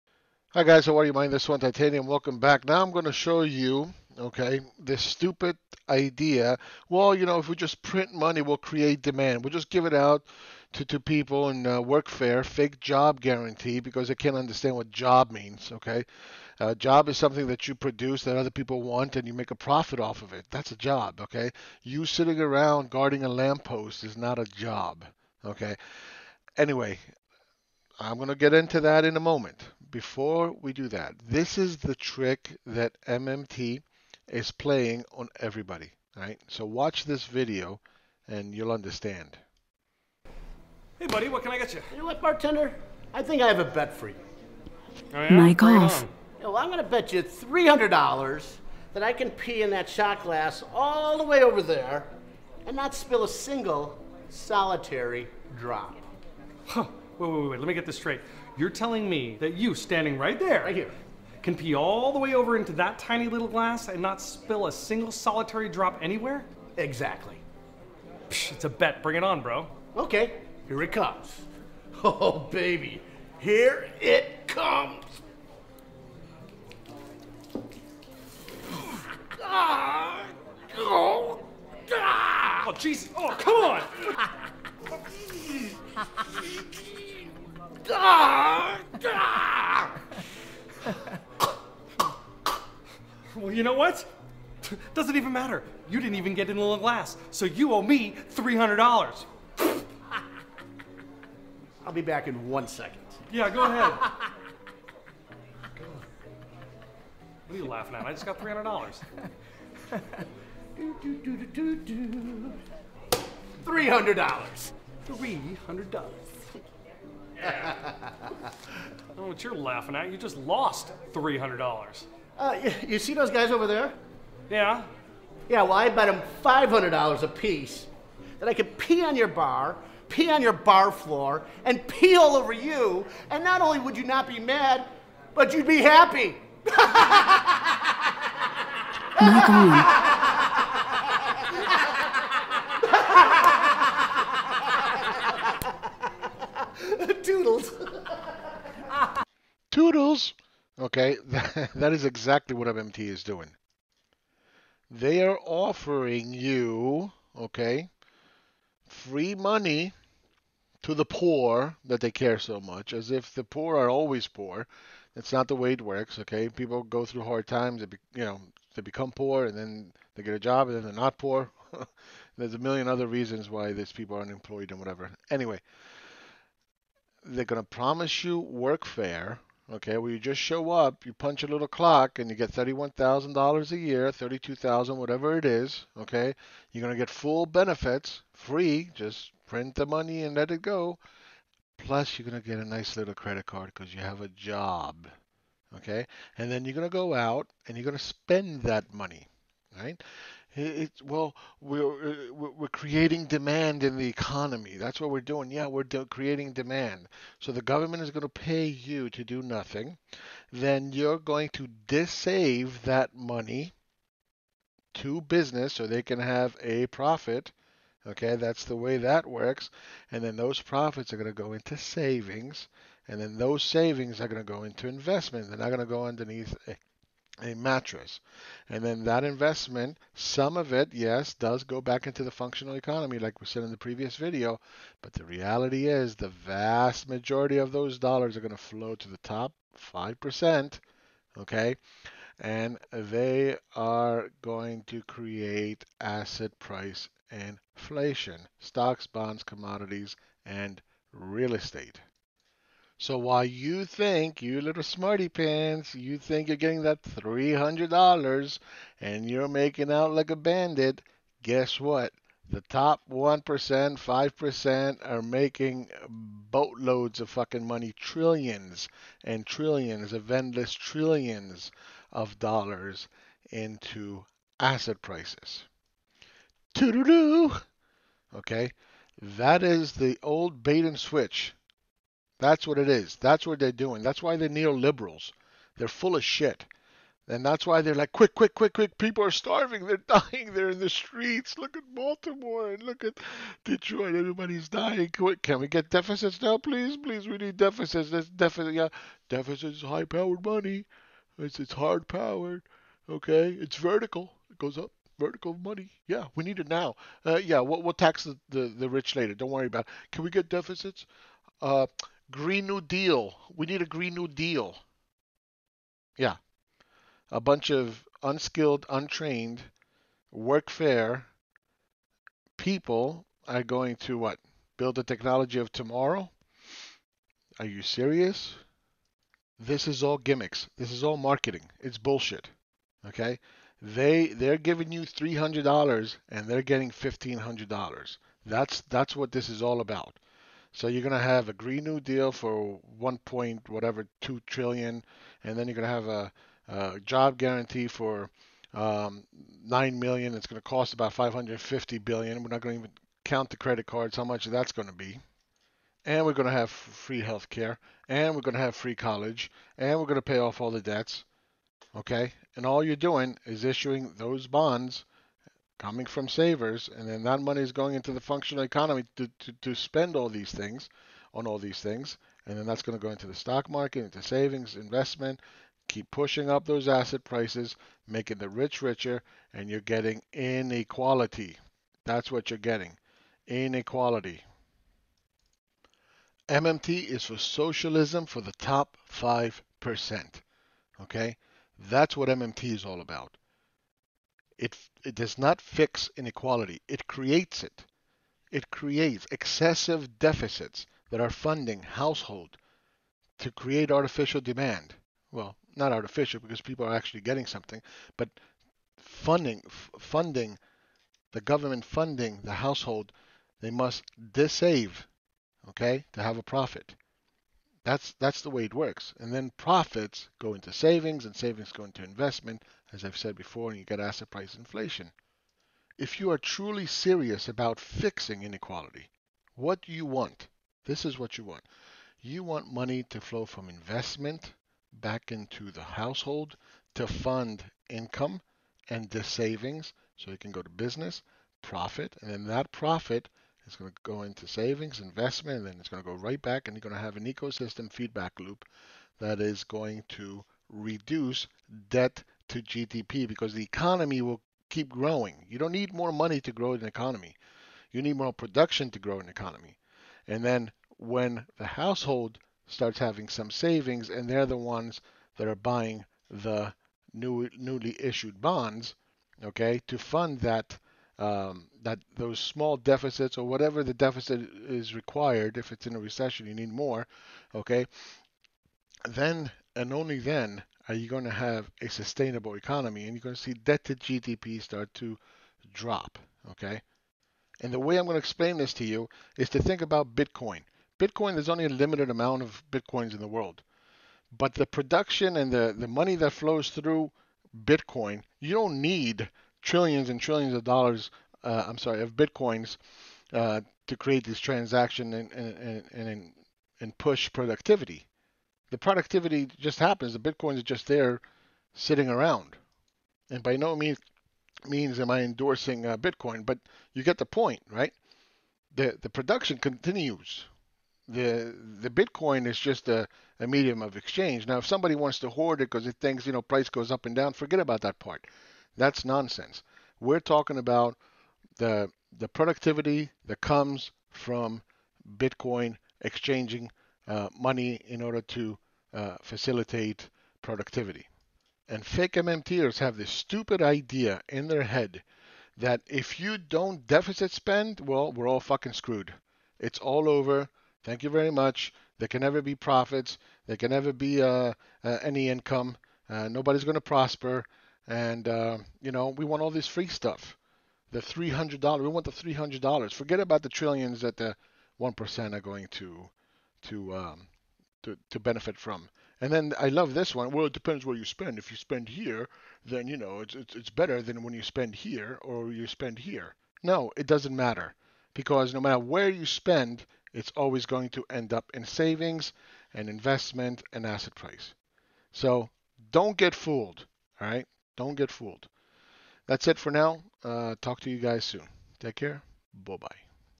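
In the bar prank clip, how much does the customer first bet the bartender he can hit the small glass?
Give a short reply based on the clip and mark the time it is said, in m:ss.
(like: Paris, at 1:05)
$300, at 0:47.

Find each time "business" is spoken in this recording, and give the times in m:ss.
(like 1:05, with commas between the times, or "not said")
3:35, 7:20.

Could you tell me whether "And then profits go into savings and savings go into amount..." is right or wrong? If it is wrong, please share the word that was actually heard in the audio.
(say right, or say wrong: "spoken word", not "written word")
wrong: "investment", not "amount".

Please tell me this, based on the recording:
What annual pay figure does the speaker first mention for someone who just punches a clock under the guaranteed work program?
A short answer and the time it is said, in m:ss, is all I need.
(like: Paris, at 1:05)
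$31,000, at 3:02.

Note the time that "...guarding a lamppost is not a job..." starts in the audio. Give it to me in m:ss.
0:22.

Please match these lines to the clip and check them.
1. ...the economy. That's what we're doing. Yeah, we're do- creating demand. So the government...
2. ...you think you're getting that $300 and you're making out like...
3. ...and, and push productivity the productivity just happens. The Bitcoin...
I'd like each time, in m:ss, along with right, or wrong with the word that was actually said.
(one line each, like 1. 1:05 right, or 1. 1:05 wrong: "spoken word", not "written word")
1. 3:23 right
2. 4:15 right
3. 8:26 right.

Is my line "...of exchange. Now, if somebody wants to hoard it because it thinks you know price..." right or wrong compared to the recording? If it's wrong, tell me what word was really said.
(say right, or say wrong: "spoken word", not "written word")
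right.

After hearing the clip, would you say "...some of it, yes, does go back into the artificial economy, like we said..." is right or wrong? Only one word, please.
wrong.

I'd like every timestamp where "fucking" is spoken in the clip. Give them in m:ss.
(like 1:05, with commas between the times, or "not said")
4:27, 9:08.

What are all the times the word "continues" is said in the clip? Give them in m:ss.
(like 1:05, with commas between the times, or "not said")
8:39.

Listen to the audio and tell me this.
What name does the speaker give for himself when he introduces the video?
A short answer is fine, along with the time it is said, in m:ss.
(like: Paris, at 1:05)
Swan Titanium, at 0:01.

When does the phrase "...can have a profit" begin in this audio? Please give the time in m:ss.
3:36.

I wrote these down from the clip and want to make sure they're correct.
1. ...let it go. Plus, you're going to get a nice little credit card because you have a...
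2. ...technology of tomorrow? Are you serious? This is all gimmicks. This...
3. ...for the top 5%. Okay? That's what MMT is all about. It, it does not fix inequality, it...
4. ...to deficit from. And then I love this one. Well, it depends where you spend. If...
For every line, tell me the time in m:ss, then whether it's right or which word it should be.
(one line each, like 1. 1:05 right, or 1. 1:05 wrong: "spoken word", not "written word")
1. 3:10 right
2. 5:25 right
3. 6:28 right
4. 9:28 wrong: "benefit", not "deficit".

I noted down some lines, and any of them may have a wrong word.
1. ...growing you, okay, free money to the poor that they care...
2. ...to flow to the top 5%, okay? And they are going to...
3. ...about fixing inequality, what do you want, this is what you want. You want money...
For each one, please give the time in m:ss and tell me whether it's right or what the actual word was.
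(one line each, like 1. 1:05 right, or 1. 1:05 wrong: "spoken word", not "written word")
1. 2:35 wrong: "offering", not "growing"
2. 3:58 right
3. 7:07 right.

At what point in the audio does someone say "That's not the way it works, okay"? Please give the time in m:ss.
2:45.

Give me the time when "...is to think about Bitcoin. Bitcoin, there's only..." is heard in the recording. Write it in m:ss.
8:09.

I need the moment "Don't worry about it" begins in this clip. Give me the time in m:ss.
5:09.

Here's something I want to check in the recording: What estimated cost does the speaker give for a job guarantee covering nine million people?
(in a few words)
$550 billion.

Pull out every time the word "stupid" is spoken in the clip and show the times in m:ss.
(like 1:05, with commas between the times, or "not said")
0:05, 9:03.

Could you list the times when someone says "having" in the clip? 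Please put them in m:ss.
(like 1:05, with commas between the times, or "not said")
7:42.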